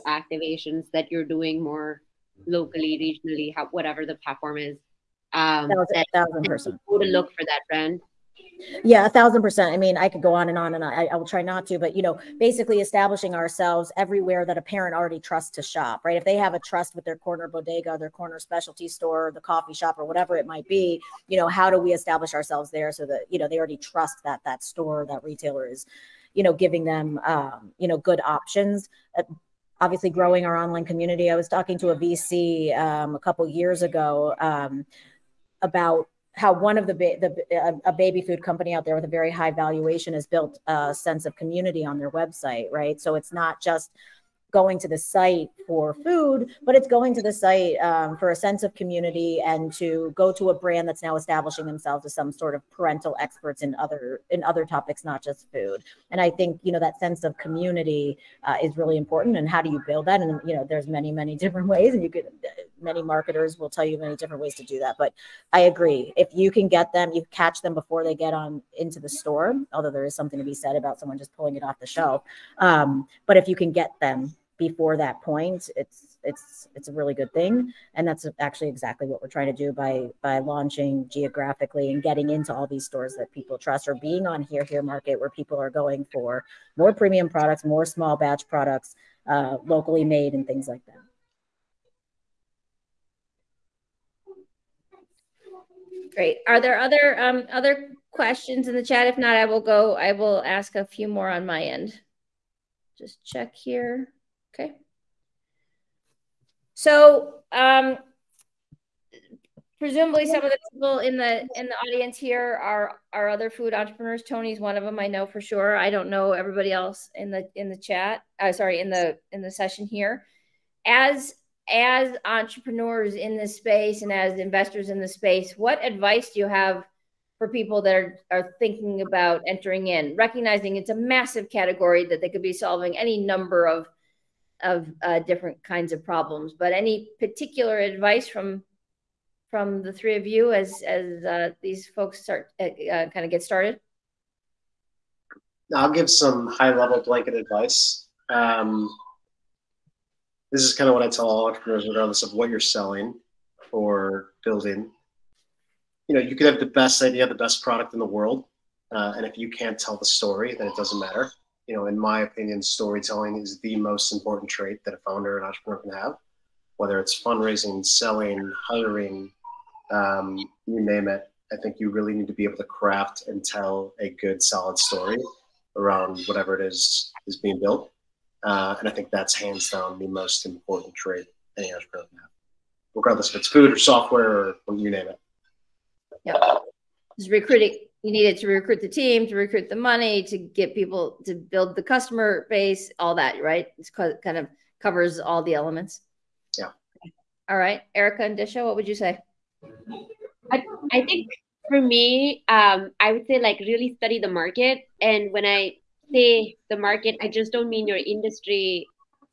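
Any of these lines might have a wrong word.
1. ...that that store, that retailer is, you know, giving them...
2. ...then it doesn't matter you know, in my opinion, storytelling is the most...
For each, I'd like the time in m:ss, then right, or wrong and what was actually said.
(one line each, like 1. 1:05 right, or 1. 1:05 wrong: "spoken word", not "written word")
1. 0:24 right
2. 2:40 right.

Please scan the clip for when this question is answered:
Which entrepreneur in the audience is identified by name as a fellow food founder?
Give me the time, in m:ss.
1:54.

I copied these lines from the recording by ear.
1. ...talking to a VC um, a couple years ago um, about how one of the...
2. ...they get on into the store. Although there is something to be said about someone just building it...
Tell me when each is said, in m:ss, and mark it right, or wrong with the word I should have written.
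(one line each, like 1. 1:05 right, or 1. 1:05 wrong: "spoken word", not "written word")
1. 0:31 right
2. 1:08 wrong: "pulling", not "building".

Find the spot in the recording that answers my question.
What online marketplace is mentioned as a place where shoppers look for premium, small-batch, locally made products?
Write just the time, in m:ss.
1:24.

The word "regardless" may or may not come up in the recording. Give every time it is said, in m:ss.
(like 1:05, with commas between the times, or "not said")
2:31, 3:02.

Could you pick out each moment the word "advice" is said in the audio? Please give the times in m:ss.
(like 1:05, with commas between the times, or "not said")
2:05, 2:17, 2:27.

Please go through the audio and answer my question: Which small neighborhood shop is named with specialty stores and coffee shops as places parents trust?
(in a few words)
bodega.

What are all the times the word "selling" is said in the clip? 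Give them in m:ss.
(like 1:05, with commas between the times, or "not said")
2:32, 2:47.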